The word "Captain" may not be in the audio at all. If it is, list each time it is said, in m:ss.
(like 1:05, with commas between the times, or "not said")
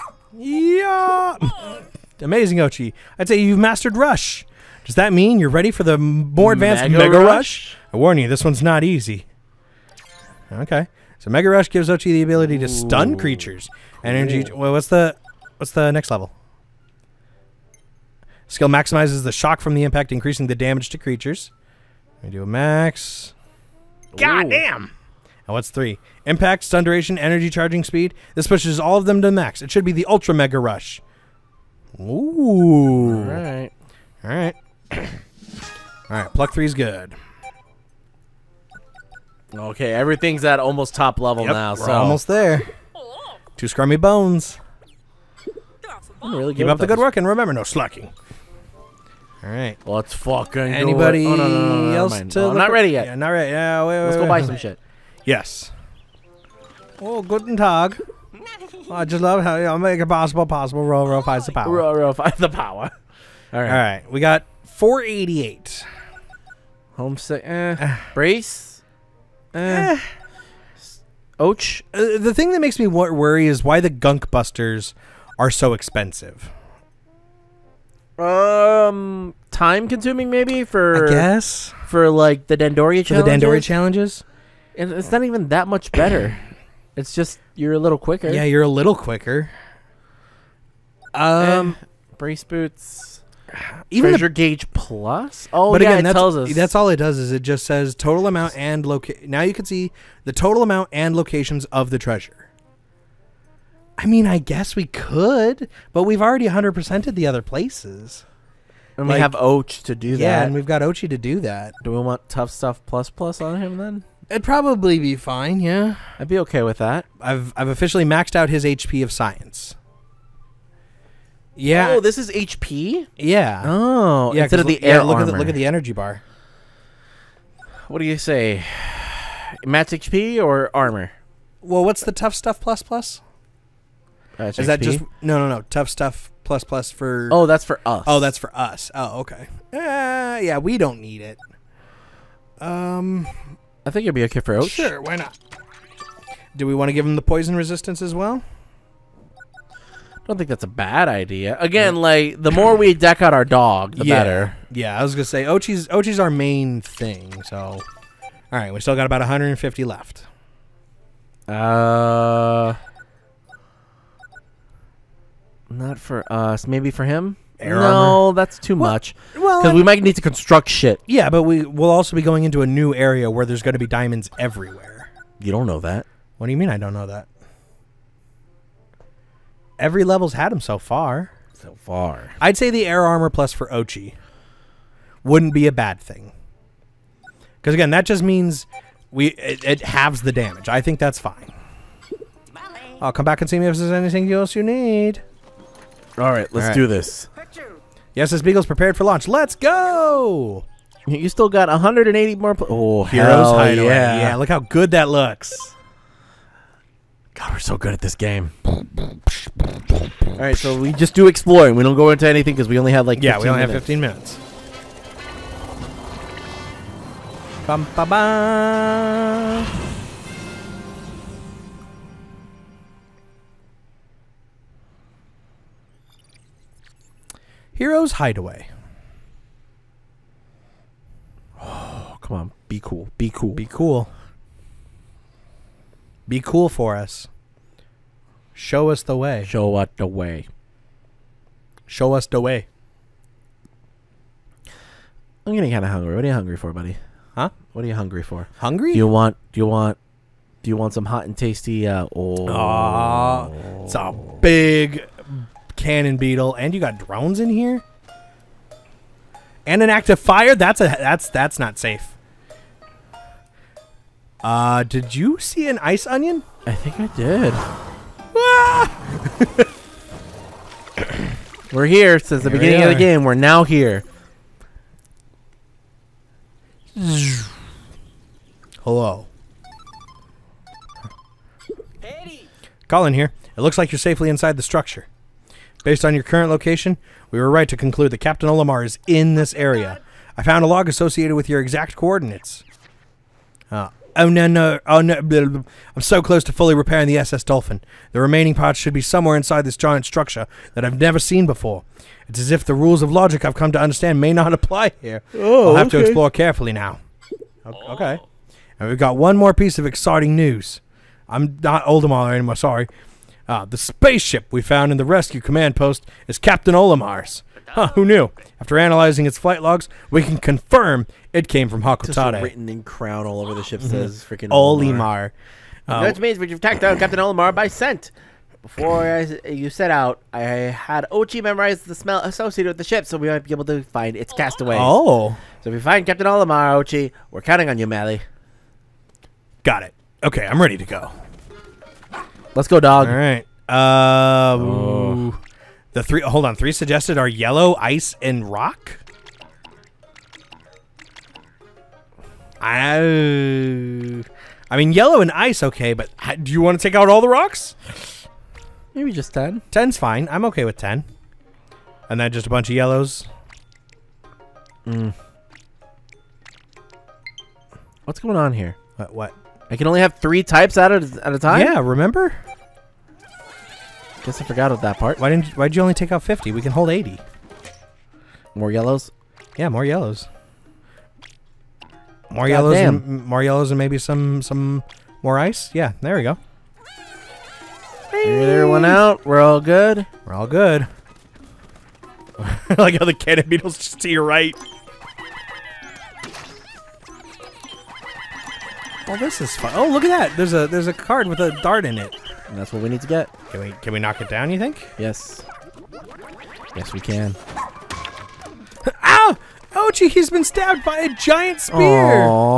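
4:48, 5:16, 5:26, 5:36.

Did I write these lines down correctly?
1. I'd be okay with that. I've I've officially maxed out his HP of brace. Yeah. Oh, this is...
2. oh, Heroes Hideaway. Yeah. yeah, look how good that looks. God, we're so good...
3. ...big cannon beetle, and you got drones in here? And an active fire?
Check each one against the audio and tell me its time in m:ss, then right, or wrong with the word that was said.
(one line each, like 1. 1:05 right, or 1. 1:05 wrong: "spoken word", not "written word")
1. 1:56 wrong: "science", not "brace"
2. 3:22 right
3. 4:14 right.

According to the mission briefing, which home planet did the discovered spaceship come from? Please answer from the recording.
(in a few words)
Hocotate.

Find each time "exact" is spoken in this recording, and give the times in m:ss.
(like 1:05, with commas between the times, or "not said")
4:51.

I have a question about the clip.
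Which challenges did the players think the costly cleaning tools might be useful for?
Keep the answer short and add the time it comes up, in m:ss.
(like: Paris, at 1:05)
Dendoria challenges, at 1:23.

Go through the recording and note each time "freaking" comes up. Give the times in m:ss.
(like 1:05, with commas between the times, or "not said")
5:24.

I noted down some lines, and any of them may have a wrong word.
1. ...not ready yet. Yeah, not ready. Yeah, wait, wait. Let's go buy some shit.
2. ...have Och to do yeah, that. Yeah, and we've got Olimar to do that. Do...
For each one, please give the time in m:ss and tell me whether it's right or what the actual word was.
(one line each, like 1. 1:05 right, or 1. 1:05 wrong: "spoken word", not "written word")
1. 0:52 right
2. 1:49 wrong: "Oatchi", not "Olimar".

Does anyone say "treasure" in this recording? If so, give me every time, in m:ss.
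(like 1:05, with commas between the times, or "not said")
1:34, 1:41.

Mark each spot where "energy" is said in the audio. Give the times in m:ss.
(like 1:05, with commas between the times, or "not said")
0:14, 0:27, 2:05.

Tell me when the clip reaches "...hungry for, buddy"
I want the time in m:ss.
4:06.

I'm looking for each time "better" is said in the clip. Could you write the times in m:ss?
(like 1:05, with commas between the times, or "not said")
1:25, 2:34.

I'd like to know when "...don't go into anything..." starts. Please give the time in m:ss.
3:31.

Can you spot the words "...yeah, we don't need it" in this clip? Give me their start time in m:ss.
2:20.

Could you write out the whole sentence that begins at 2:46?
Maybe for him air no, armor.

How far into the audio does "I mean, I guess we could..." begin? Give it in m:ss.
1:43.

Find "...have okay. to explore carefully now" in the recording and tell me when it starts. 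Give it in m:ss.
5:05.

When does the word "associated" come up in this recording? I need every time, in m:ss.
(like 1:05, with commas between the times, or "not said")
4:50, 5:32.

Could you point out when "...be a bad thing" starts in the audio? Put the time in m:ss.
3:05.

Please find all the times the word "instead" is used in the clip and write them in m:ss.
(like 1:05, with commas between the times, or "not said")
2:04.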